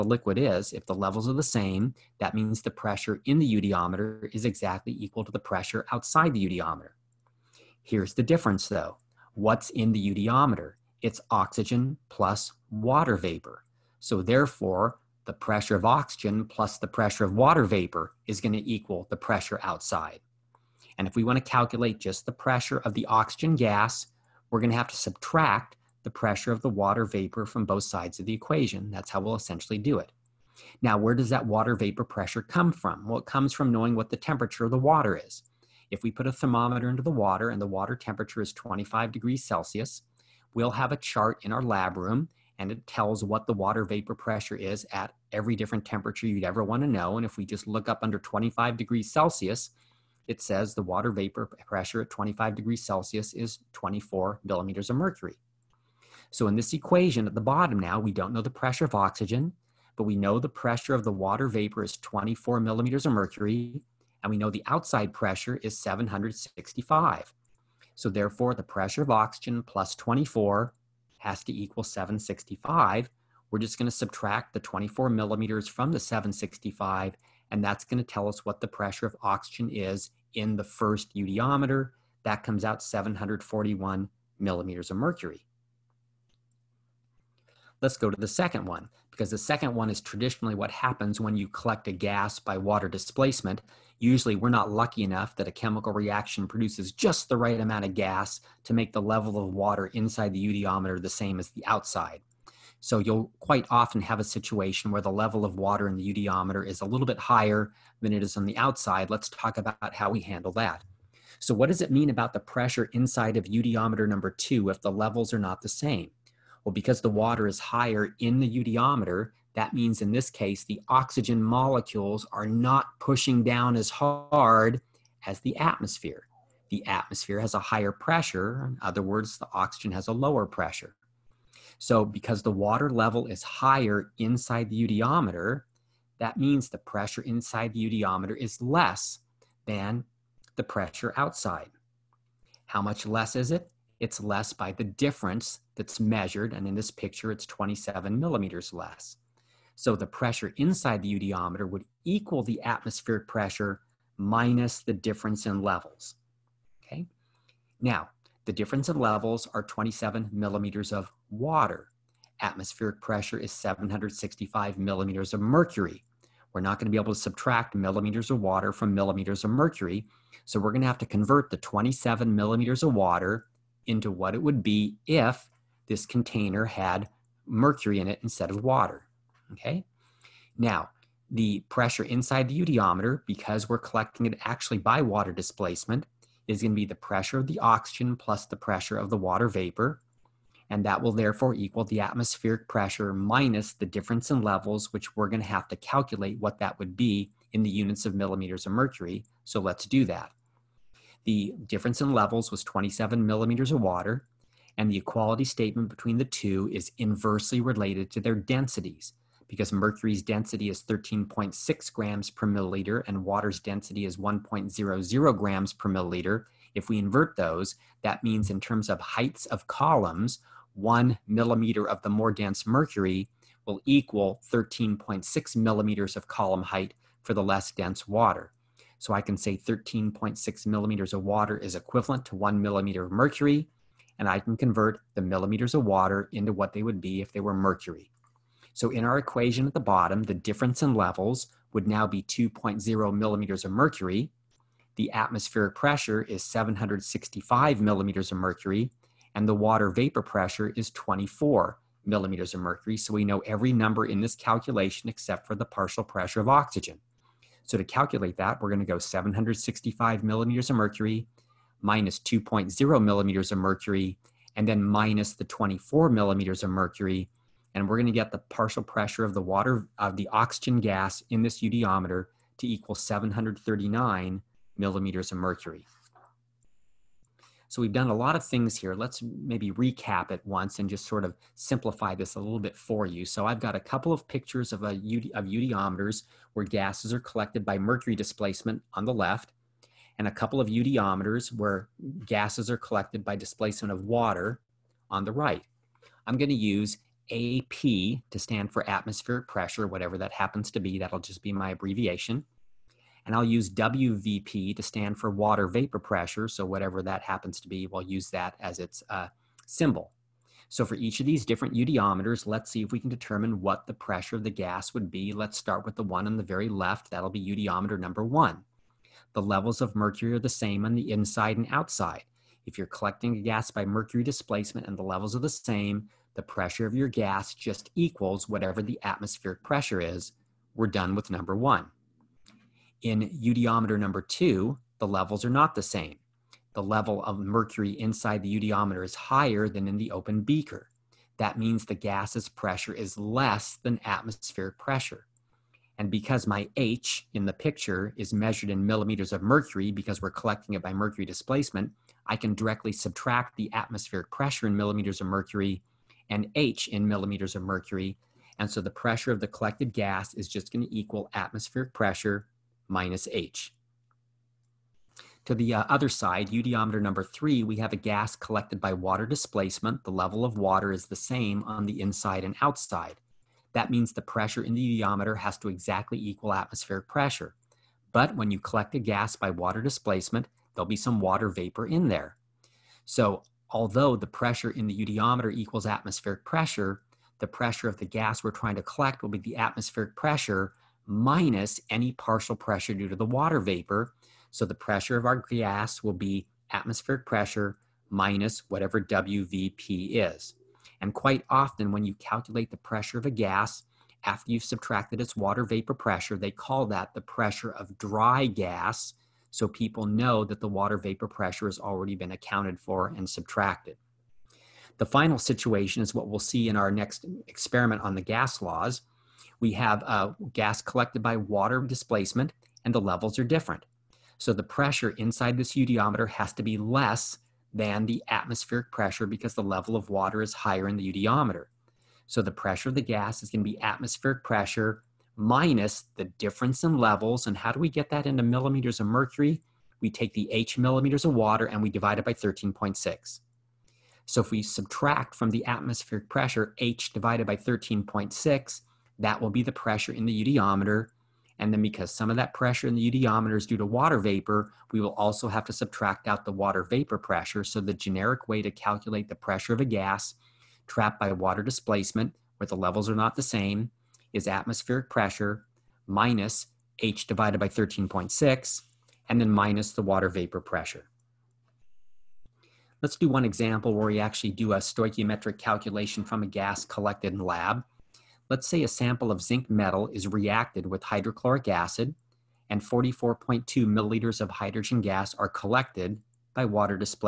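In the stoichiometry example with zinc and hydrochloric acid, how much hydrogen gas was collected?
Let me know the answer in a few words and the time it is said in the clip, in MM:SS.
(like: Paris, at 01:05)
44.2 milliliters, at 08:02.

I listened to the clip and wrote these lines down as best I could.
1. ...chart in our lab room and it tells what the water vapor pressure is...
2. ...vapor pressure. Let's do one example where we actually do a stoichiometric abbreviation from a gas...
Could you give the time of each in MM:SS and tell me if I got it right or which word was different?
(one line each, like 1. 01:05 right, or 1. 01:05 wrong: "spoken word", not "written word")
1. 00:40 right
2. 07:50 wrong: "calculation", not "abbreviation".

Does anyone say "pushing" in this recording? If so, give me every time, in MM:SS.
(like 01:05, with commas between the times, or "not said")
02:02.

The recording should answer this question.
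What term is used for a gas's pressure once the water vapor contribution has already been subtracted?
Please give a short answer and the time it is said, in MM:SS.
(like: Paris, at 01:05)
pressure of dry gas, at 06:47.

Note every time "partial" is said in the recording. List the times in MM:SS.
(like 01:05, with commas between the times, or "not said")
04:15, 04:28, 06:32.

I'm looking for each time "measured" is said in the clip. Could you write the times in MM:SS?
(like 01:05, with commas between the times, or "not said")
02:25, 05:48.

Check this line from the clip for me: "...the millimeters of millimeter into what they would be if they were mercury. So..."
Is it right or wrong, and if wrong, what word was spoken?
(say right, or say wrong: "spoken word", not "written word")
wrong: "water", not "millimeter".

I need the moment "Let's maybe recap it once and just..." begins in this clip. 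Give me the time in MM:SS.
04:38.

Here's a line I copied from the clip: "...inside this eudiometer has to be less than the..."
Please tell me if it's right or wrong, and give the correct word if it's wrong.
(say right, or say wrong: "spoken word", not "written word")
right.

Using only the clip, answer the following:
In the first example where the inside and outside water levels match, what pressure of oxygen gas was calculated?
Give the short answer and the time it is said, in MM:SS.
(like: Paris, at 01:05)
741 millimeters of mercury, at 01:22.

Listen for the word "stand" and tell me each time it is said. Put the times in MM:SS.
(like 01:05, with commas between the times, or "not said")
04:58, 05:04.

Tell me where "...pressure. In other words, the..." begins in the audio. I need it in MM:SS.
02:07.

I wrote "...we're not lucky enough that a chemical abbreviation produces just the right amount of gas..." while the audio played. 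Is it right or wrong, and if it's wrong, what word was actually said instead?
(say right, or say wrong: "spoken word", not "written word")
wrong: "reaction", not "abbreviation".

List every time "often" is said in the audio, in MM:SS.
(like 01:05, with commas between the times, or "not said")
01:43, 06:41.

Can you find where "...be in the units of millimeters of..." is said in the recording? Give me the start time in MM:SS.
03:16.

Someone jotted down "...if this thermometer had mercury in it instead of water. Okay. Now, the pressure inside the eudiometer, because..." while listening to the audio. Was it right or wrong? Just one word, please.
wrong.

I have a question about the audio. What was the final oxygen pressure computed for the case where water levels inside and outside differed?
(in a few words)
739 millimeters of mercury.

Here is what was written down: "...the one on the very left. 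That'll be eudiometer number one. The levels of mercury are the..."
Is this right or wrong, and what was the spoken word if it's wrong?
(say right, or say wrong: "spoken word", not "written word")
right.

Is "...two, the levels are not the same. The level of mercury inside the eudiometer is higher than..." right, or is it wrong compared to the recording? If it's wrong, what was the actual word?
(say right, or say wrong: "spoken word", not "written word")
right.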